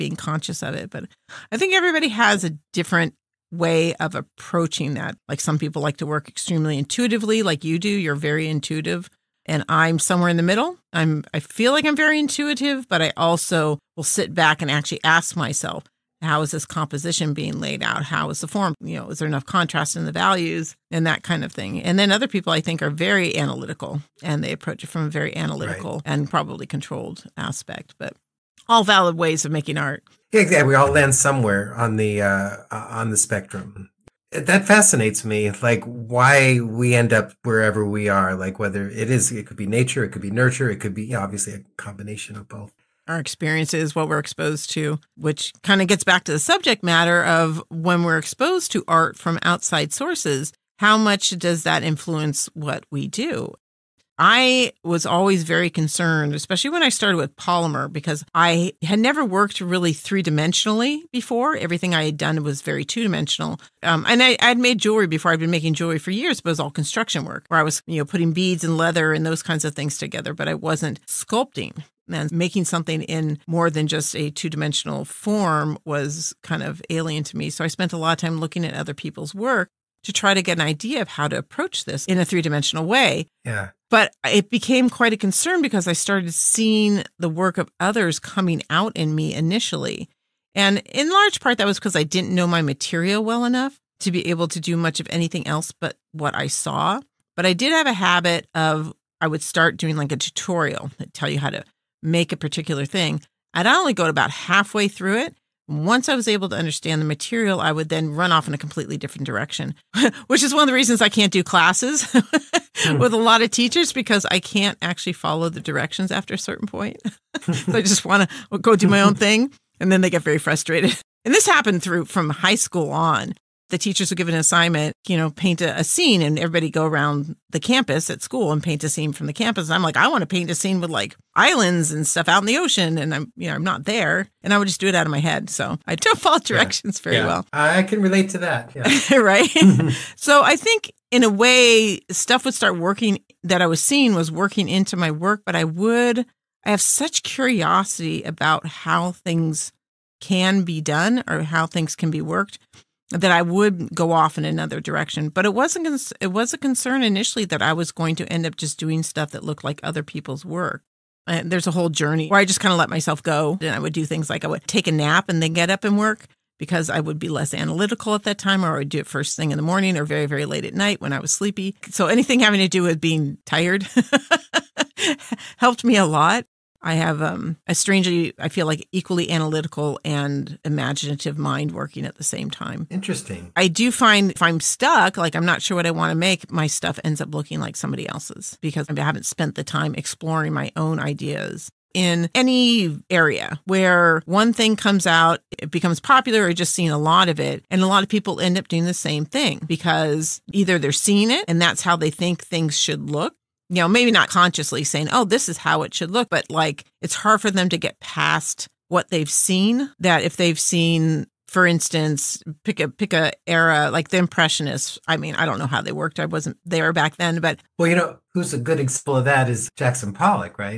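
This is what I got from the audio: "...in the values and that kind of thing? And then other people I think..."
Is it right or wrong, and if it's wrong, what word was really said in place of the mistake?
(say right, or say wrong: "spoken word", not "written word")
right.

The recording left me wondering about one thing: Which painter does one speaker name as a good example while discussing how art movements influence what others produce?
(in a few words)
Jackson Pollock.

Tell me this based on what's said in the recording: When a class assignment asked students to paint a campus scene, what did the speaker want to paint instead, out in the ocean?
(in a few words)
islands.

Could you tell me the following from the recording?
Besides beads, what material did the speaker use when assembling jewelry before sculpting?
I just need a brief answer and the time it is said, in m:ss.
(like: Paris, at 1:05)
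leather, at 1:08.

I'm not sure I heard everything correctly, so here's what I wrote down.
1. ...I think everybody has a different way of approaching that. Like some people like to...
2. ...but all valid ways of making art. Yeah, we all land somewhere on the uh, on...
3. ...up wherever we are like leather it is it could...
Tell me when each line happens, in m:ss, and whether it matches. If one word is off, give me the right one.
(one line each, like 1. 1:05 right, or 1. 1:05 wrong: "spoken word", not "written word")
1. 0:01 right
2. 0:27 right
3. 0:37 wrong: "whether", not "leather".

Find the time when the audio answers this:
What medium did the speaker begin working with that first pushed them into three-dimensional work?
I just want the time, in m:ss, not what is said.
0:57.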